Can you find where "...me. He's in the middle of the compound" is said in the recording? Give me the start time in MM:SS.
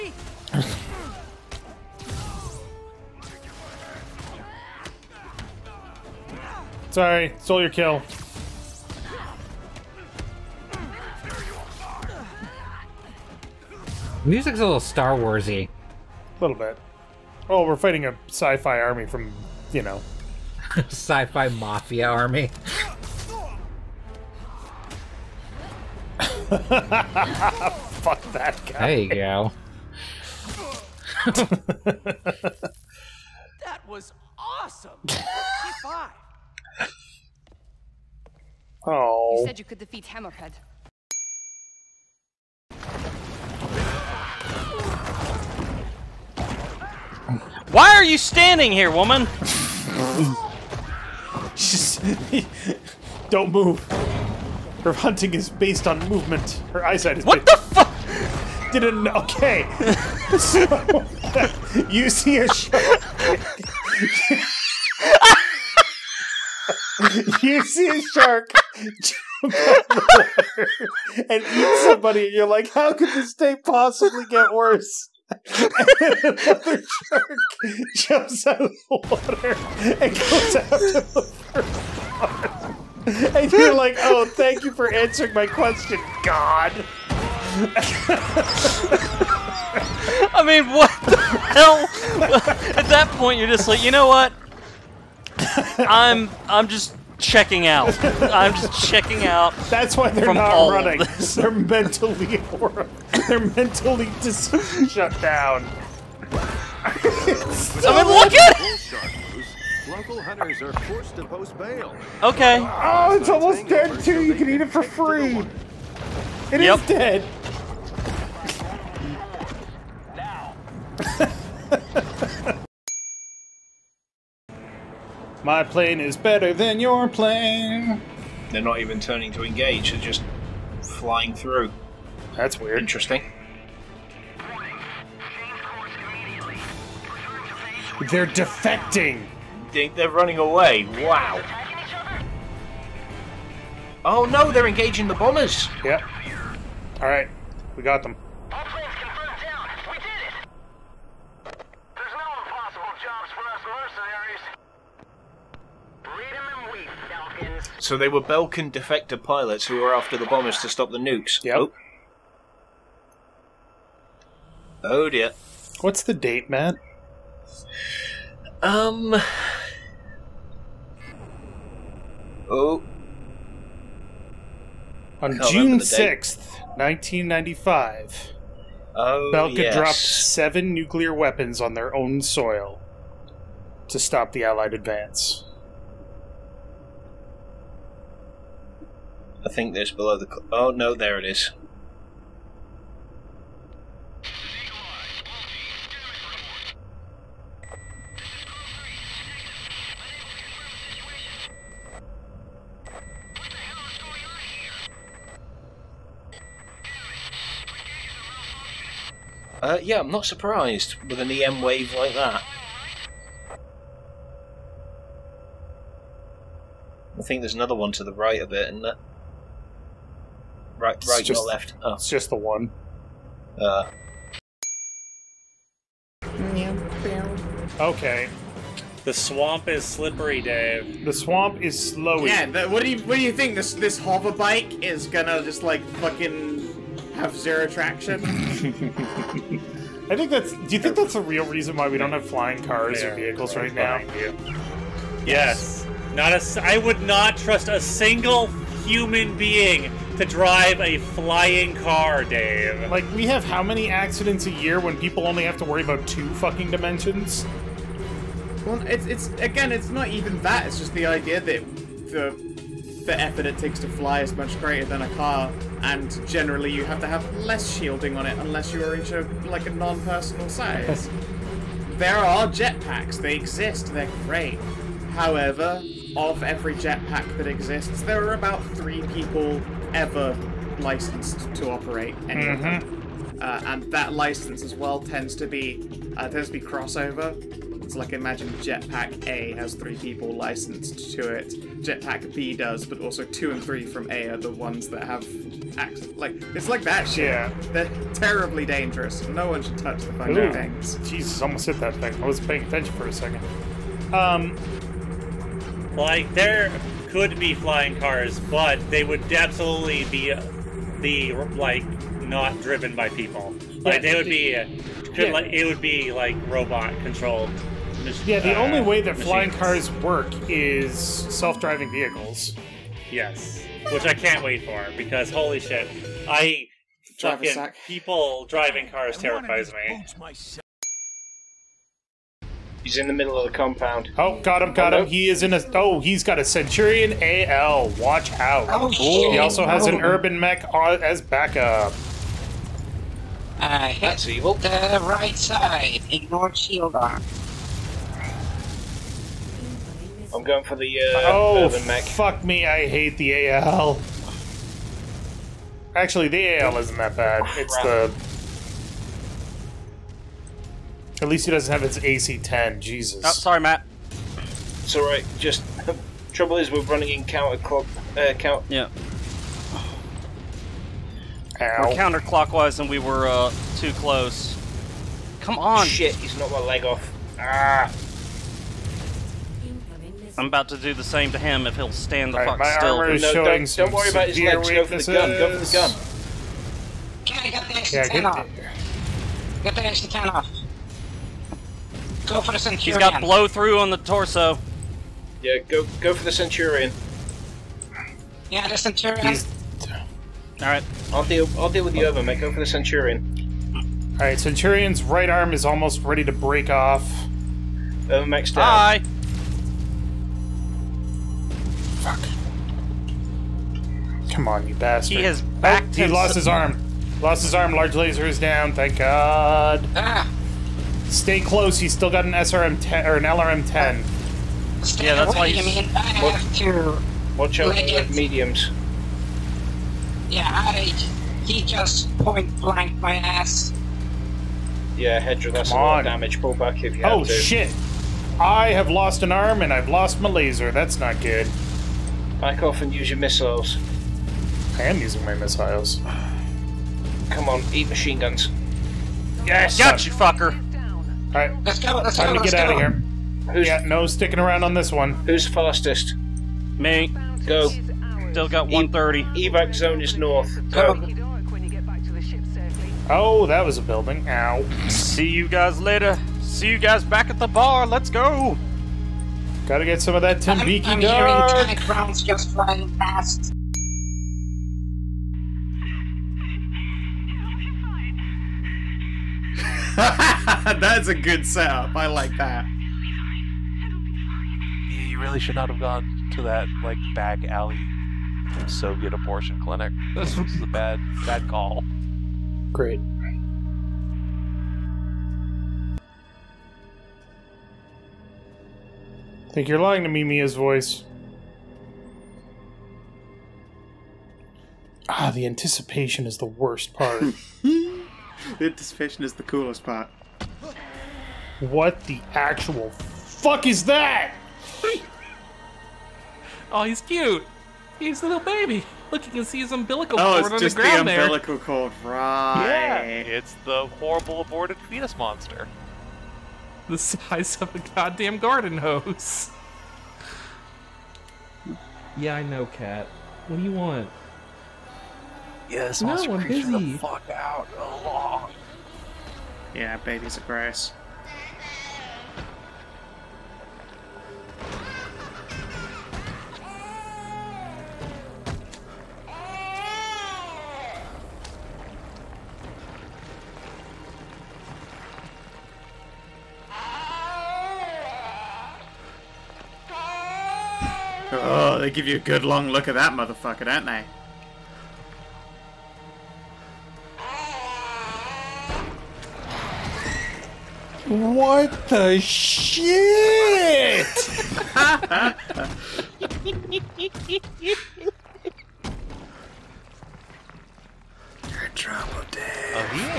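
05:29.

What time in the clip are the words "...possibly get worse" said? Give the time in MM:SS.
01:13.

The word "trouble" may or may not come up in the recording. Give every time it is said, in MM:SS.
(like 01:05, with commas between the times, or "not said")
06:06, 09:41.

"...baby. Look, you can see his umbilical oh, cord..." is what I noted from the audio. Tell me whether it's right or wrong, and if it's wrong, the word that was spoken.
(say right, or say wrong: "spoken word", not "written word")
right.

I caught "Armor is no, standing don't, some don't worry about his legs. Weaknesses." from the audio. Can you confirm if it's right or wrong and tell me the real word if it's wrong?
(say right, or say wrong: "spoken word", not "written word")
wrong: "showing", not "standing".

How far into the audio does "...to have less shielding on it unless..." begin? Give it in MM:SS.
04:26.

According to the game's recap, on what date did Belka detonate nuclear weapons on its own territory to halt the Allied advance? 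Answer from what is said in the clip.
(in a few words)
June 6th, 1995.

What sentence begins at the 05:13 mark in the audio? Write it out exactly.
Like yeah, they would be, could, yeah.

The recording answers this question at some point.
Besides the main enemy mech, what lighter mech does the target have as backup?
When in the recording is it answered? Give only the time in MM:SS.
05:40.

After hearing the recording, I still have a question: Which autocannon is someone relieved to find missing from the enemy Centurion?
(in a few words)
AC-10.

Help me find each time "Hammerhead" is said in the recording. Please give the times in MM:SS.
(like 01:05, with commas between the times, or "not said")
00:40.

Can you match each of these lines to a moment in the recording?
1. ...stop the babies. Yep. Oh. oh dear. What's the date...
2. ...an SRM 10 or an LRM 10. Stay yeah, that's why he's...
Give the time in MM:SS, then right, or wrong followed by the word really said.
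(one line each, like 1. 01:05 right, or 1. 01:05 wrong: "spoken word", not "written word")
1. 02:40 wrong: "nukes", not "babies"
2. 07:02 right.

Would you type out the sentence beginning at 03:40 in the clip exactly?
Right, right, it's just, not left.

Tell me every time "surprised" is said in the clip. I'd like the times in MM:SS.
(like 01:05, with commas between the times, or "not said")
03:30.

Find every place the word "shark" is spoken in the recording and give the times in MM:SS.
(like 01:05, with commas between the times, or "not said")
01:02, 01:08, 01:17.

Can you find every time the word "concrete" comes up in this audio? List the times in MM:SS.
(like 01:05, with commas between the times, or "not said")
not said.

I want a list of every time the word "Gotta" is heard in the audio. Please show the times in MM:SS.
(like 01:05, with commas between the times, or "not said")
07:49.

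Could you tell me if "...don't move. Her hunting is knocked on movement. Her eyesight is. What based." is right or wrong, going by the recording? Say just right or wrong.
wrong.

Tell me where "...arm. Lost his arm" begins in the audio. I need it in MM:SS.
06:56.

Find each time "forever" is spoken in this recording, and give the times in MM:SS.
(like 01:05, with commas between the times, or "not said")
not said.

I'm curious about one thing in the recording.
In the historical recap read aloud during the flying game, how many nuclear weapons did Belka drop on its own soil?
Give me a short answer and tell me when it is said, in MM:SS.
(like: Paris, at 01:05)
7, at 02:59.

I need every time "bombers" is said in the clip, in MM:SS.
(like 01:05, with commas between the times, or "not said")
02:25, 02:40.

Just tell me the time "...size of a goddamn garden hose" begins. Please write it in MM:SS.
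08:46.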